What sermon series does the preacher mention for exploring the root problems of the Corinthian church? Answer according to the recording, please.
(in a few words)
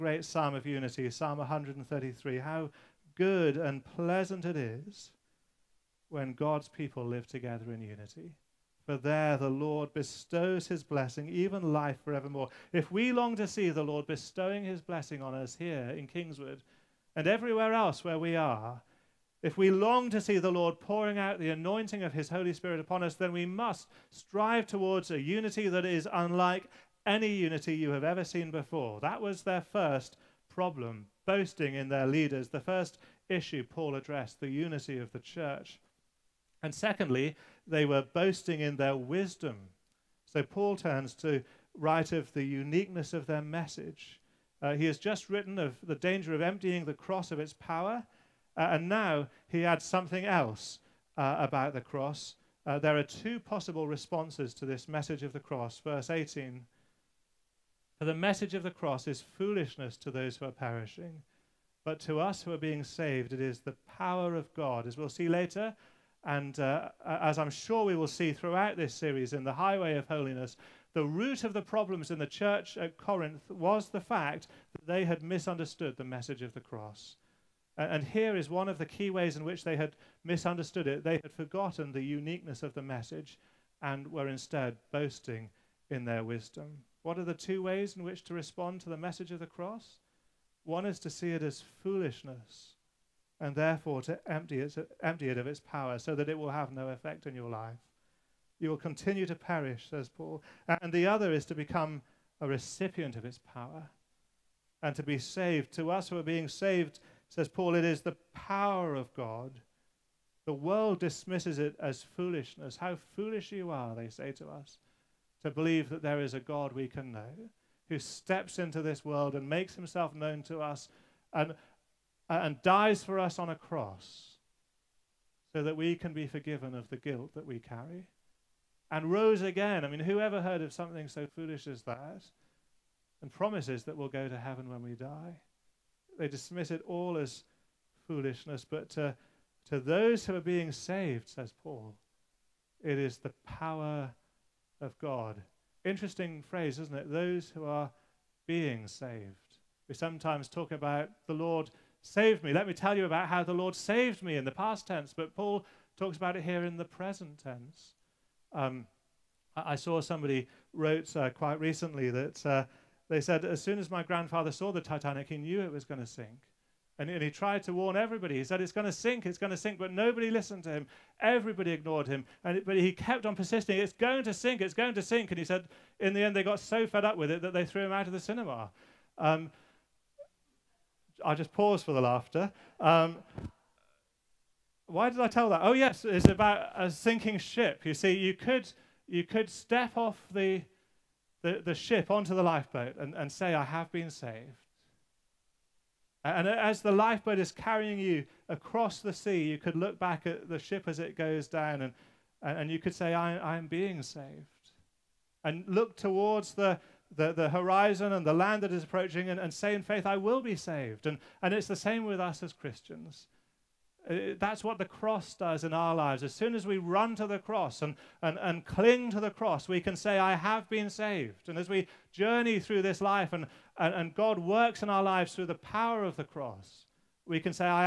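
Highway of Holiness.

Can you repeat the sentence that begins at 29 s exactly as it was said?
That was their first problem, boasting in their leaders, the first issue Paul addressed, the unity of the church.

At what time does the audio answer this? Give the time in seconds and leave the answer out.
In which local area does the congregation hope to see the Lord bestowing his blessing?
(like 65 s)
16 s.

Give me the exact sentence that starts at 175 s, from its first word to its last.
And he said, In the end, they got so fed up with it that they threw him out of the cinema.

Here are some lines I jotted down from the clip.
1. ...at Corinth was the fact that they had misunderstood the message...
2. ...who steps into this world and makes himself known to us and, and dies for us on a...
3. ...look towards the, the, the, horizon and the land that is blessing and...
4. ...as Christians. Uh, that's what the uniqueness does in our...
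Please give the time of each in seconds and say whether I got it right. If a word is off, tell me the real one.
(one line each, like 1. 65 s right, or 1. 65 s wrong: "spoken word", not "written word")
1. 72 s right
2. 117 s right
3. 205 s wrong: "approaching", not "blessing"
4. 212 s wrong: "cross", not "uniqueness".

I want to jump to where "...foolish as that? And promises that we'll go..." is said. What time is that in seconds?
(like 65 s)
131 s.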